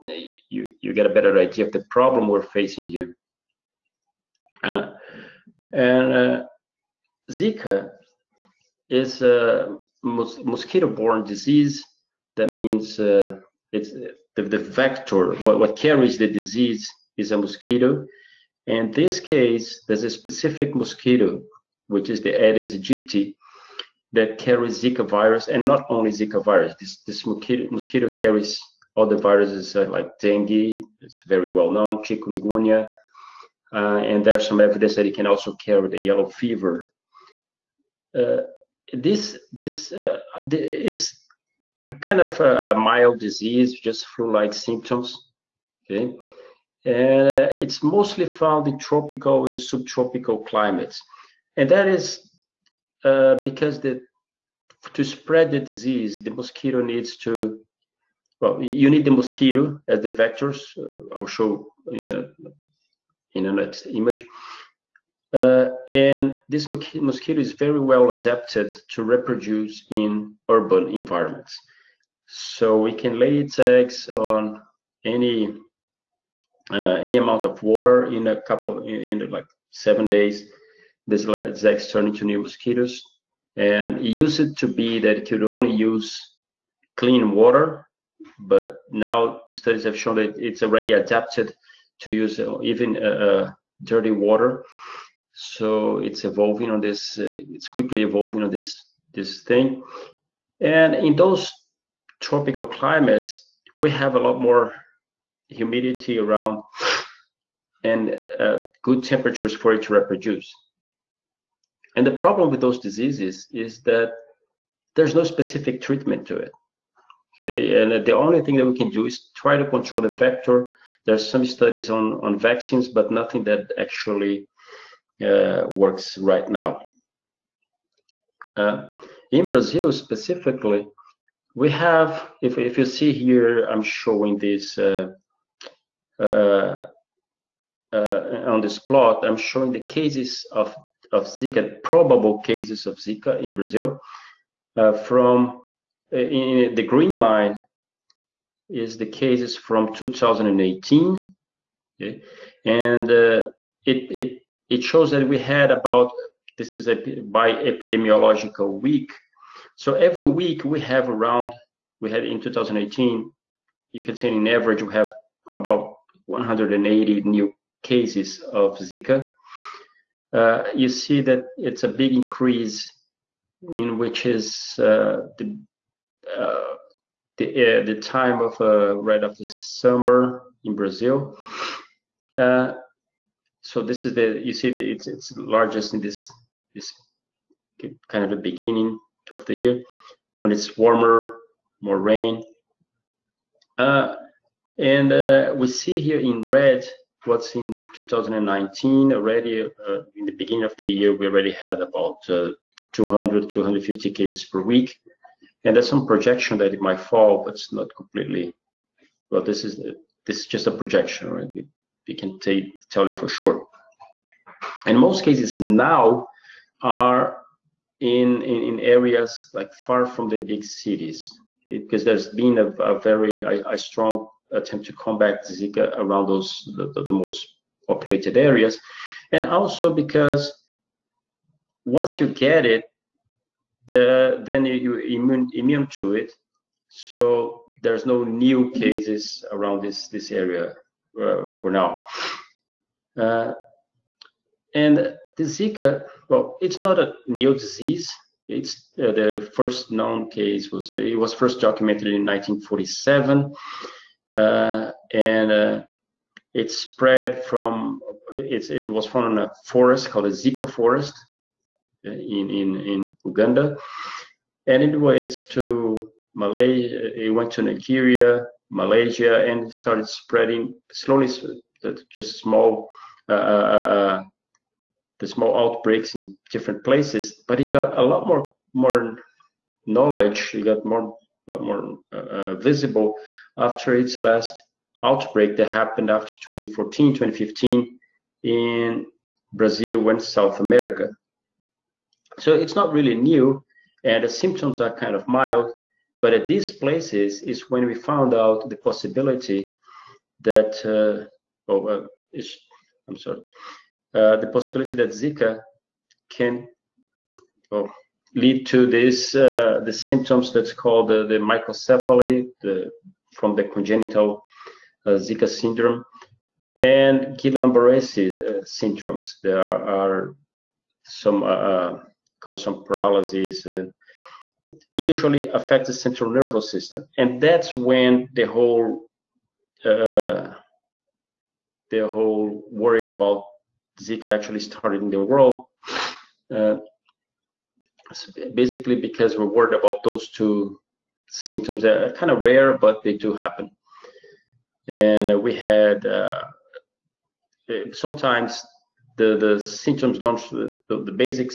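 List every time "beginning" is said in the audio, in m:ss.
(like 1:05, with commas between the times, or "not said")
3:08, 3:20.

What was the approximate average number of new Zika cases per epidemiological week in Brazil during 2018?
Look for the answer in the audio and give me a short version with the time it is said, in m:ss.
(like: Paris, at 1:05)
180, at 2:46.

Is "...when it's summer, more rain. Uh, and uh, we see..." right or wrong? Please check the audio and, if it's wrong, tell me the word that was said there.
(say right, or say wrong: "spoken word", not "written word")
wrong: "warmer", not "summer".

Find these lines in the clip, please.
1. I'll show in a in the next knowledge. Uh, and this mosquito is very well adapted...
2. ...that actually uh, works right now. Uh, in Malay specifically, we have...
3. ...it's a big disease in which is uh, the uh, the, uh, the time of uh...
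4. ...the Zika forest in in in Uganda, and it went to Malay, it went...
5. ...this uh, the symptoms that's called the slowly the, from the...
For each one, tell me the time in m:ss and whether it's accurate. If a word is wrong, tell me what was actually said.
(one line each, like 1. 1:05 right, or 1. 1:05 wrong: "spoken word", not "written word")
1. 1:01 wrong: "image", not "knowledge"
2. 2:03 wrong: "Brazil", not "Malay"
3. 2:51 wrong: "increase", not "disease"
4. 4:20 right
5. 5:08 wrong: "microcephaly", not "slowly".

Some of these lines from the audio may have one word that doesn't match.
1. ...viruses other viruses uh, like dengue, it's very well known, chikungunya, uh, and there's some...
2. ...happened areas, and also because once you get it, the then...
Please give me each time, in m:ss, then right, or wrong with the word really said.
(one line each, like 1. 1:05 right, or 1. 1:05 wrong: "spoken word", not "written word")
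1. 0:28 wrong: "carries", not "viruses"
2. 3:47 wrong: "populated", not "happened".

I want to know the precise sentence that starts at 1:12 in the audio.
So it can lay its eggs on any uh, any amount of water in a couple of in, in like seven days.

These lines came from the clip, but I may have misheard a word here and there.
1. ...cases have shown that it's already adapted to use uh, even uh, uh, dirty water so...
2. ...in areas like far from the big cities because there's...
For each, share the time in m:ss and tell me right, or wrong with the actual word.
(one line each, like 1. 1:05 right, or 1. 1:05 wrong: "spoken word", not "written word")
1. 1:29 wrong: "studies", not "cases"
2. 3:38 right.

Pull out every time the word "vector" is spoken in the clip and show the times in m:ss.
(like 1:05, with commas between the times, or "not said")
0:14, 1:00, 2:00.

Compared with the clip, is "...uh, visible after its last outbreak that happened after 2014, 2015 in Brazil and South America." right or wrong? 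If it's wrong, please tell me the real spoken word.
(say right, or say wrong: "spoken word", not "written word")
right.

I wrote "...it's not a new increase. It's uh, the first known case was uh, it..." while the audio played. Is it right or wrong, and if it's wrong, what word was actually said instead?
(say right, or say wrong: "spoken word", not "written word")
wrong: "disease", not "increase".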